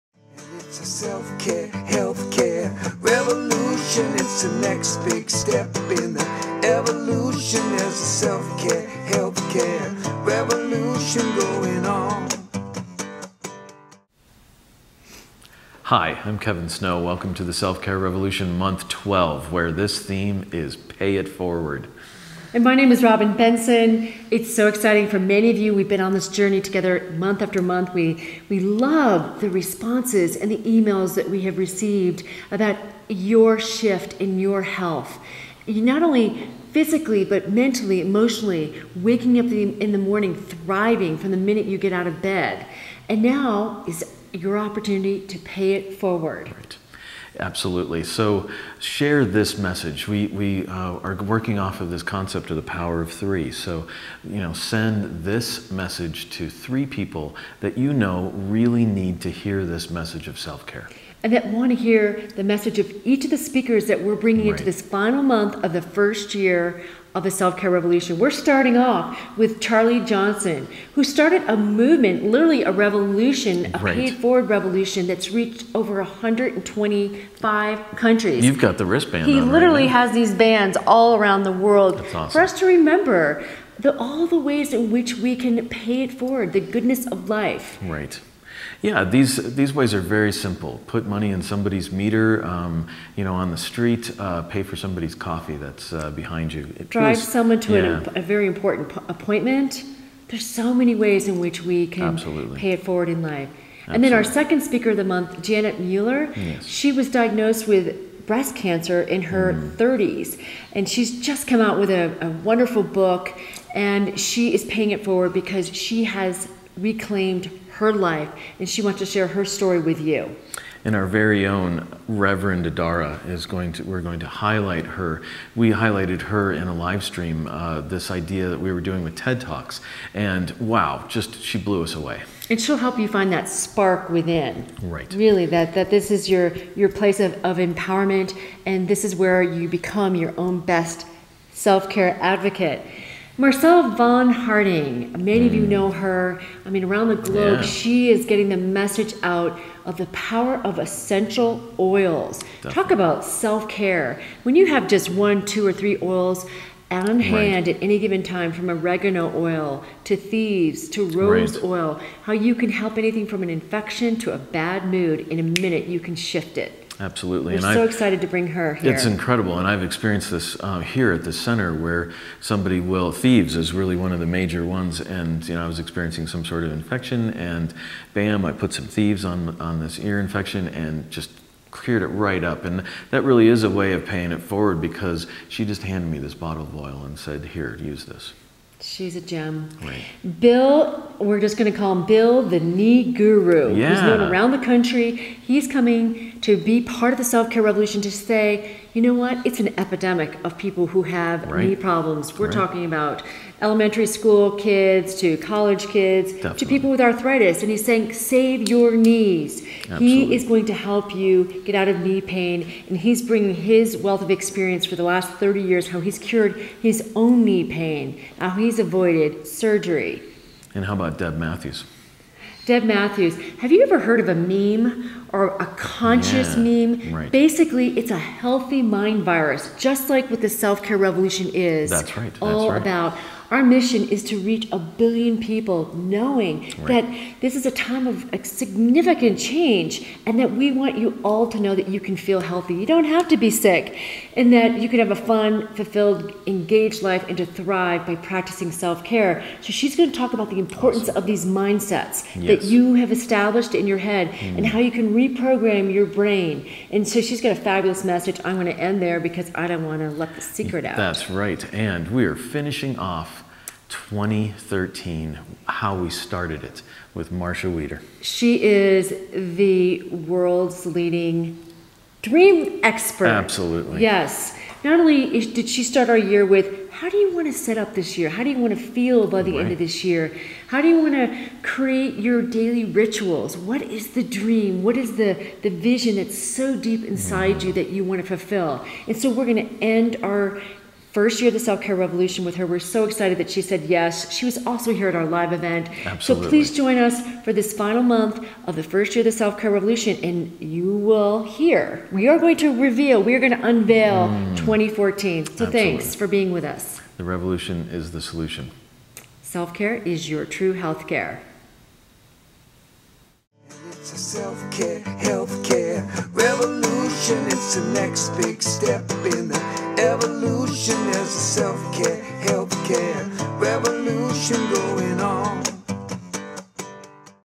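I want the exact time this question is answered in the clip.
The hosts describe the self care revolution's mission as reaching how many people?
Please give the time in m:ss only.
3:54.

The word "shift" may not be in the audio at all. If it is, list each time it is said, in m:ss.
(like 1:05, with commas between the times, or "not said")
0:33, 2:46.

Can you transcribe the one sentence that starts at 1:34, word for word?
Uh, pay for somebody's coffee that's uh, behind you.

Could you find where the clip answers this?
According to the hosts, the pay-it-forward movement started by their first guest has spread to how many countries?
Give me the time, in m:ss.
1:15.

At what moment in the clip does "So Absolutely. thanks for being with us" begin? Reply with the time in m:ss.
5:05.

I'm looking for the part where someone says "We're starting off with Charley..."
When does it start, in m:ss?
1:08.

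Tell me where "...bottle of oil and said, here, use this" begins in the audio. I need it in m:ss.
3:06.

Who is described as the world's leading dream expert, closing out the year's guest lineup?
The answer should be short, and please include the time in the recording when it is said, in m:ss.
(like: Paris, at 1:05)
Marcia Wieder, at 4:27.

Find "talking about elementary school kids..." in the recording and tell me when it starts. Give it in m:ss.
3:22.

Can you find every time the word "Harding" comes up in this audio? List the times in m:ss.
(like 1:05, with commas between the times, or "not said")
2:24.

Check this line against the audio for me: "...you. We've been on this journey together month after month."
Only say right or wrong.
right.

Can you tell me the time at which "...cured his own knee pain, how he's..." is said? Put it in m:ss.
3:36.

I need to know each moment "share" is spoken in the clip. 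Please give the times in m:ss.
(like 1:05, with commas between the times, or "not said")
0:48, 1:59.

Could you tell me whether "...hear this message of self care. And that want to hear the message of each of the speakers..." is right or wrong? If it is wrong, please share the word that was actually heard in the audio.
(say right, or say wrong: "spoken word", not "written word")
right.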